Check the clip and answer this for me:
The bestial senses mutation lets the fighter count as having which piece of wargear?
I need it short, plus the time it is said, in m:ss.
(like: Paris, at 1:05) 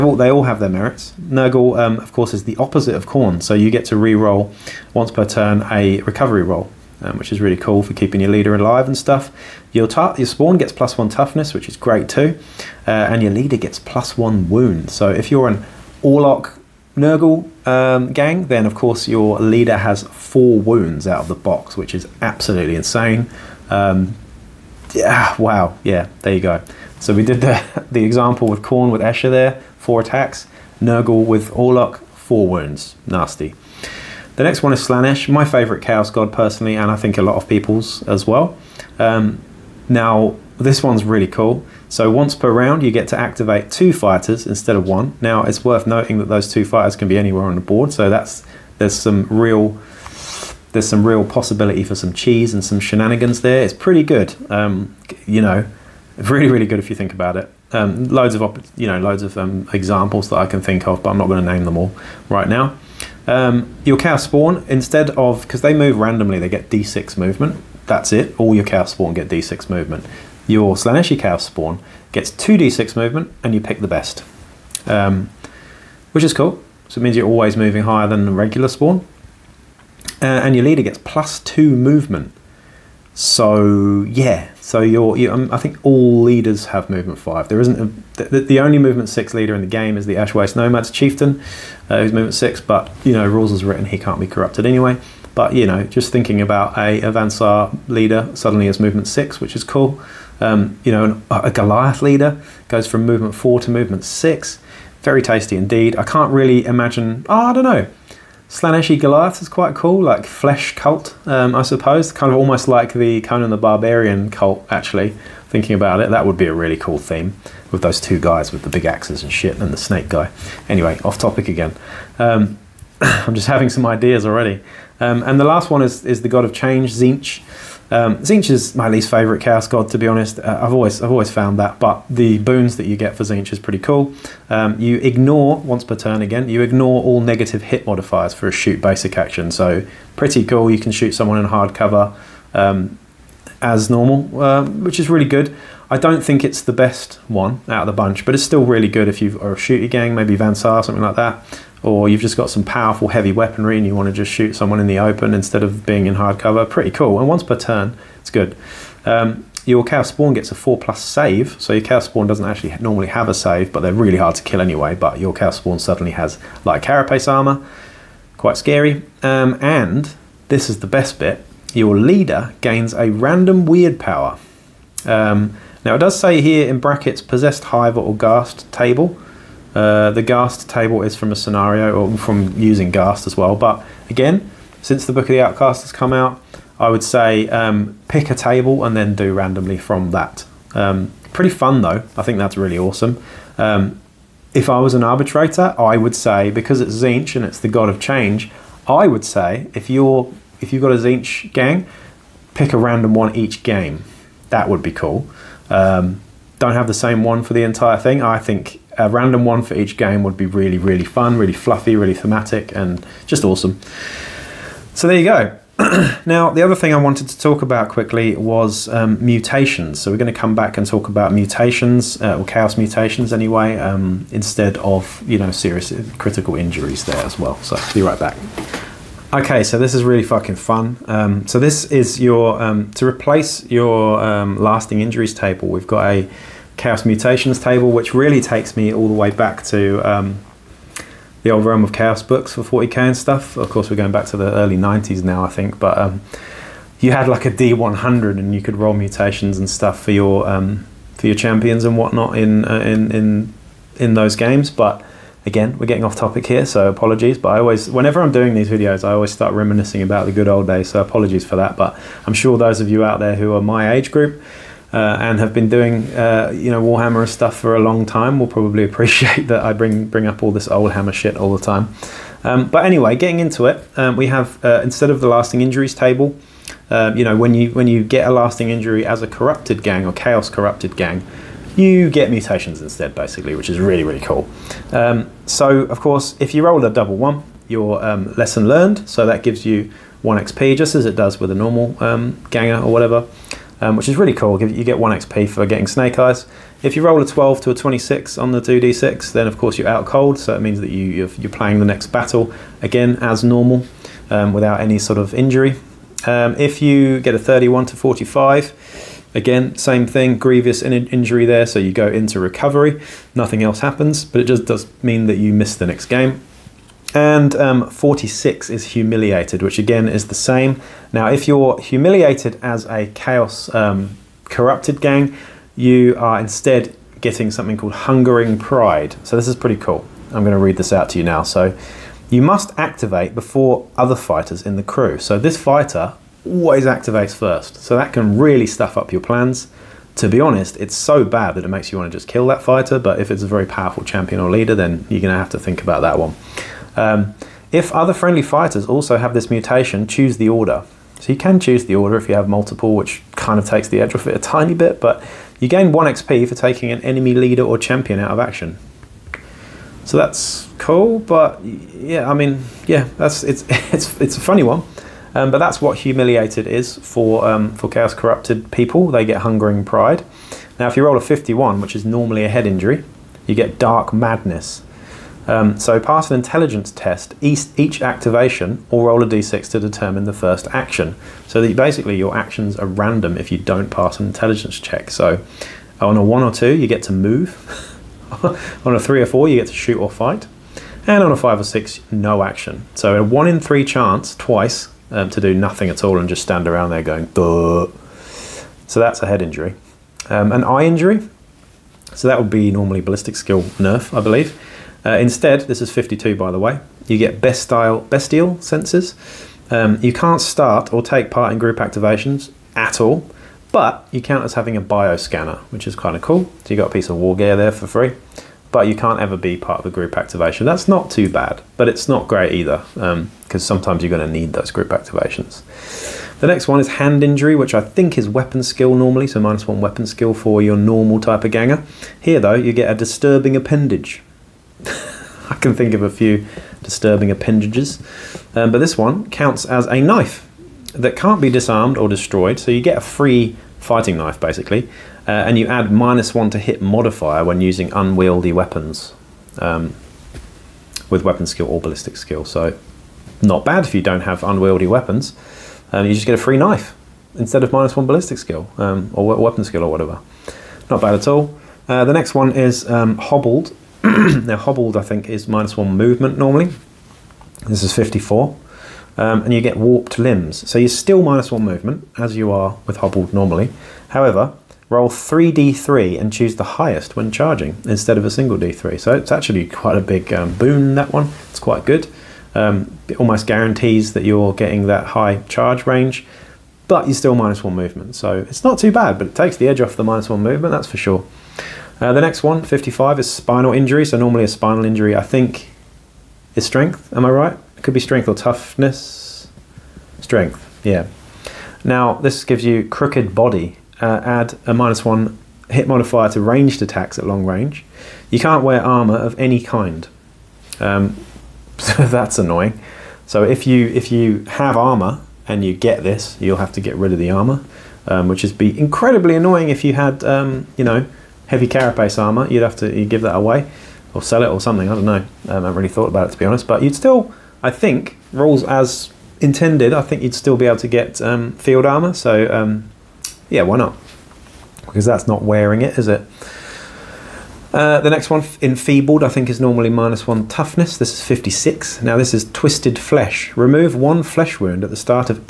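Bioscanner, at 6:54.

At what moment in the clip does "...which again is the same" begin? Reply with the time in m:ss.
5:19.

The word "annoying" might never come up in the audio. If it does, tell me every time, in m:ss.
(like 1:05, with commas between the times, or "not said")
8:32, 8:39.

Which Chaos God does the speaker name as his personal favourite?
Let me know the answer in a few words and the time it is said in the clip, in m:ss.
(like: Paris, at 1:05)
Slaanesh, at 0:34.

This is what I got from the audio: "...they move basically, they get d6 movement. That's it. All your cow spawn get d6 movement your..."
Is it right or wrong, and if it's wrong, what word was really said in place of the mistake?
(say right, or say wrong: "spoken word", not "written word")
wrong: "randomly", not "basically".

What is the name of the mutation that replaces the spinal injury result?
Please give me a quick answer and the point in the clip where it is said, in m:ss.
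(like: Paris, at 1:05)
Crooked Body, at 8:22.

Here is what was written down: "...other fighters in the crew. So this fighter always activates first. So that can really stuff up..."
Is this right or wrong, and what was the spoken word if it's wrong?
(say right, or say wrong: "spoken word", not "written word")
right.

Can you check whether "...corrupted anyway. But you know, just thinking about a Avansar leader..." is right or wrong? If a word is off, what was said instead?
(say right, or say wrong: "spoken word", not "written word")
right.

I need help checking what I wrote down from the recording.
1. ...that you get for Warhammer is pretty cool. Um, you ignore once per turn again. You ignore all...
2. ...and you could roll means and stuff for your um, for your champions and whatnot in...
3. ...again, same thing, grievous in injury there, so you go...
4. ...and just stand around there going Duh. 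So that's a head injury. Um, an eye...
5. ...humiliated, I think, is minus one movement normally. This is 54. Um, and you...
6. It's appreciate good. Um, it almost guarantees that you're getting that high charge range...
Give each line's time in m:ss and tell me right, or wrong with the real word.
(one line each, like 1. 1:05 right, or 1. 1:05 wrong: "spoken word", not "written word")
1. 2:12 wrong: "Tzeentch", not "Warhammer"
2. 4:08 wrong: "mutations", not "means"
3. 5:09 right
4. 6:36 right
5. 7:44 wrong: "hobbled", not "humiliated"
6. 8:01 wrong: "quite", not "appreciate".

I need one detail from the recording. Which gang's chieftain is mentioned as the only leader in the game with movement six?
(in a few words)
Ashwaste Nomads.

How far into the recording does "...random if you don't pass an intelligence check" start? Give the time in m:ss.
6:22.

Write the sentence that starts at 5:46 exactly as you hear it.
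Um, if other friendly fighters also have this mutation, choose the order.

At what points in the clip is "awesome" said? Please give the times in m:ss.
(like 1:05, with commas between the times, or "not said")
3:12, 3:33.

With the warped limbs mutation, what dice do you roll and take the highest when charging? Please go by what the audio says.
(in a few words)
3D3.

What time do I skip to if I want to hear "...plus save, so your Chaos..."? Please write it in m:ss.
2:40.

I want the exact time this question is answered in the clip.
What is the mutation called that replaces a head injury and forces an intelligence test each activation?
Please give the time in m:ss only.
6:13.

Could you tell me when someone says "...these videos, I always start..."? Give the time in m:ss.
4:18.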